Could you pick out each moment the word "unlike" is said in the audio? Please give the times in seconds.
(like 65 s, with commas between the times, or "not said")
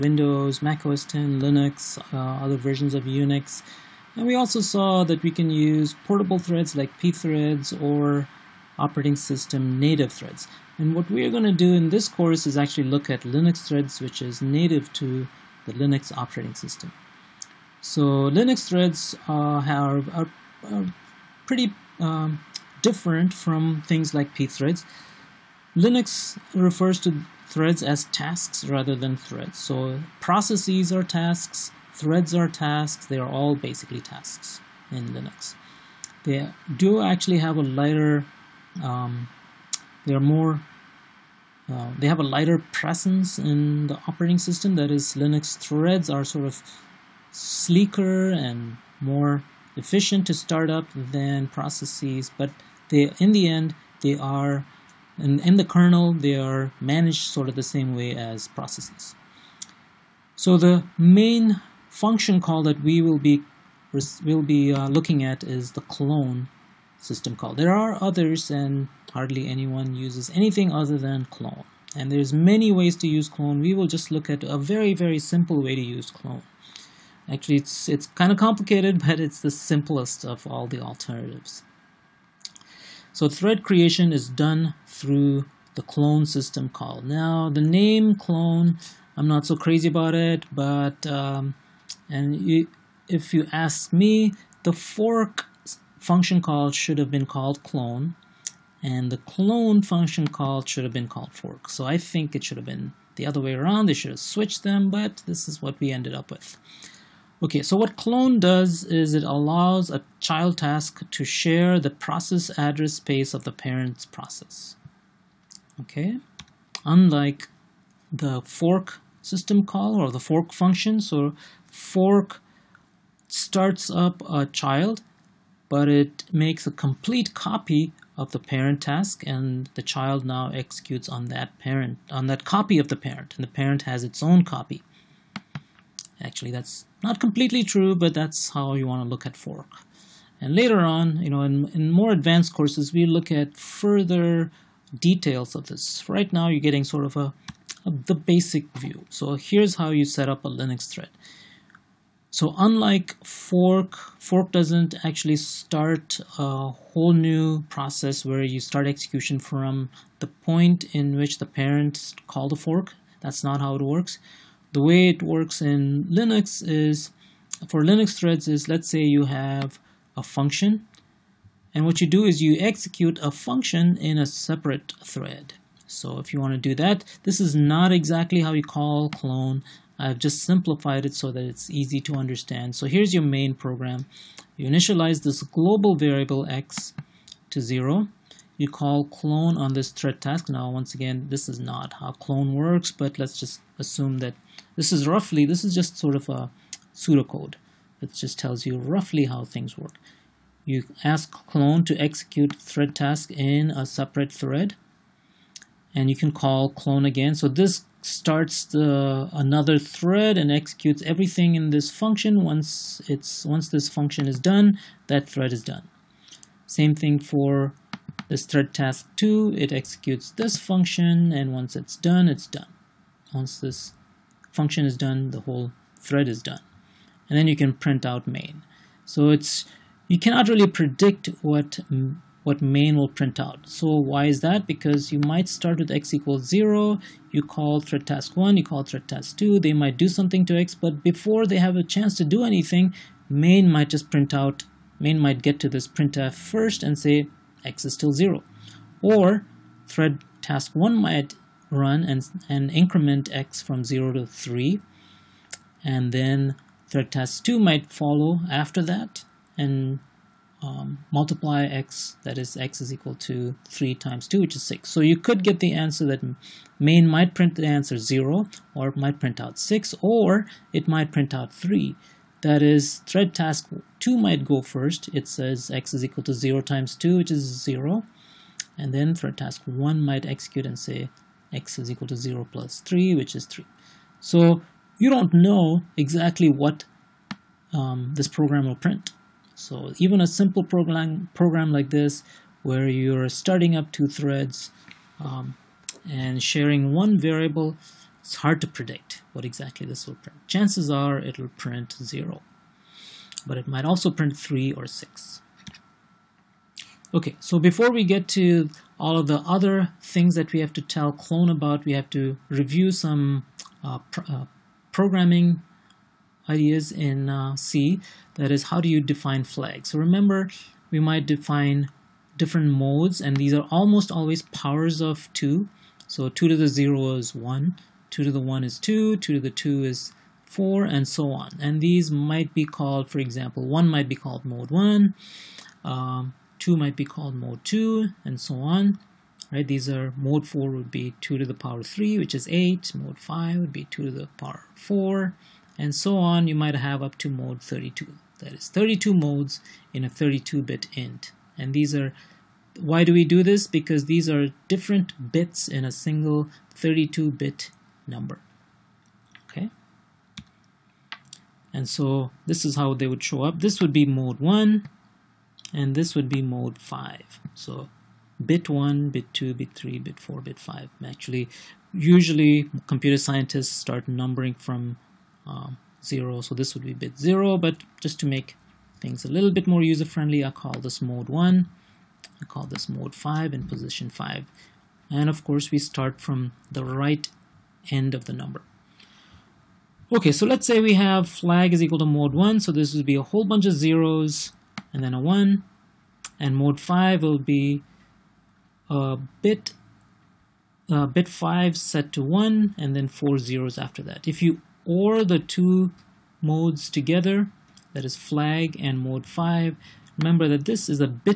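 116 s, 152 s.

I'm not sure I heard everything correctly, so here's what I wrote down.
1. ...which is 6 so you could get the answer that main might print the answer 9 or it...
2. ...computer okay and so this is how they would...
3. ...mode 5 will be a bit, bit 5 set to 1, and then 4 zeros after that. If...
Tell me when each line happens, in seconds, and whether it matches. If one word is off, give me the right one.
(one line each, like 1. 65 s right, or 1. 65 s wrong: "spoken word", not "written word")
1. 264 s wrong: "0", not "9"
2. 358 s wrong: "number", not "computer"
3. 396 s right.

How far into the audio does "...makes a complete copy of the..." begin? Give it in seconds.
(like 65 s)
126 s.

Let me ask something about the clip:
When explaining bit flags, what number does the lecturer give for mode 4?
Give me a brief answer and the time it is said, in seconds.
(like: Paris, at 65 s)
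8, at 342 s.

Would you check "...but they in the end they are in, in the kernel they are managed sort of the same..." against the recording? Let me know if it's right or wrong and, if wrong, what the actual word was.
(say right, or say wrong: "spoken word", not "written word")
right.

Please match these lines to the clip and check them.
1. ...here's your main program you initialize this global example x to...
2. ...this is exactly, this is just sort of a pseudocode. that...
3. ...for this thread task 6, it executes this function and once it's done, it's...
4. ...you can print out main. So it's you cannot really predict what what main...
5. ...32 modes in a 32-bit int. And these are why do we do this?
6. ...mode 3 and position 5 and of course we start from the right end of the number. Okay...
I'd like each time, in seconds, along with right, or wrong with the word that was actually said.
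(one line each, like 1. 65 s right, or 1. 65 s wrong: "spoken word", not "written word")
1. 182 s wrong: "variable", not "example"
2. 194 s wrong: "roughly", not "exactly"
3. 217 s wrong: "2", not "6"
4. 227 s right
5. 348 s right
6. 382 s wrong: "5", not "3".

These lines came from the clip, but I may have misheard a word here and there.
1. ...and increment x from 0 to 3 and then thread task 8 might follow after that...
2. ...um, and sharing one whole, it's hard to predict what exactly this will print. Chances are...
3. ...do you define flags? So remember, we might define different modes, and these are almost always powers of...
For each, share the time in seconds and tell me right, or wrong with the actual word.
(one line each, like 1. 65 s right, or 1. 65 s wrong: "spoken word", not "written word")
1. 252 s wrong: "2", not "8"
2. 295 s wrong: "variable", not "whole"
3. 318 s right.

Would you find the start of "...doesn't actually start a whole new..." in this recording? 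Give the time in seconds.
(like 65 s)
154 s.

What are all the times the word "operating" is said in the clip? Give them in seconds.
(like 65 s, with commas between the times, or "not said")
8 s, 16 s, 44 s.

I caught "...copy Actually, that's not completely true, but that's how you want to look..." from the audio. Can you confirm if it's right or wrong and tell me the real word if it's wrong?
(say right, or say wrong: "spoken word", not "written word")
right.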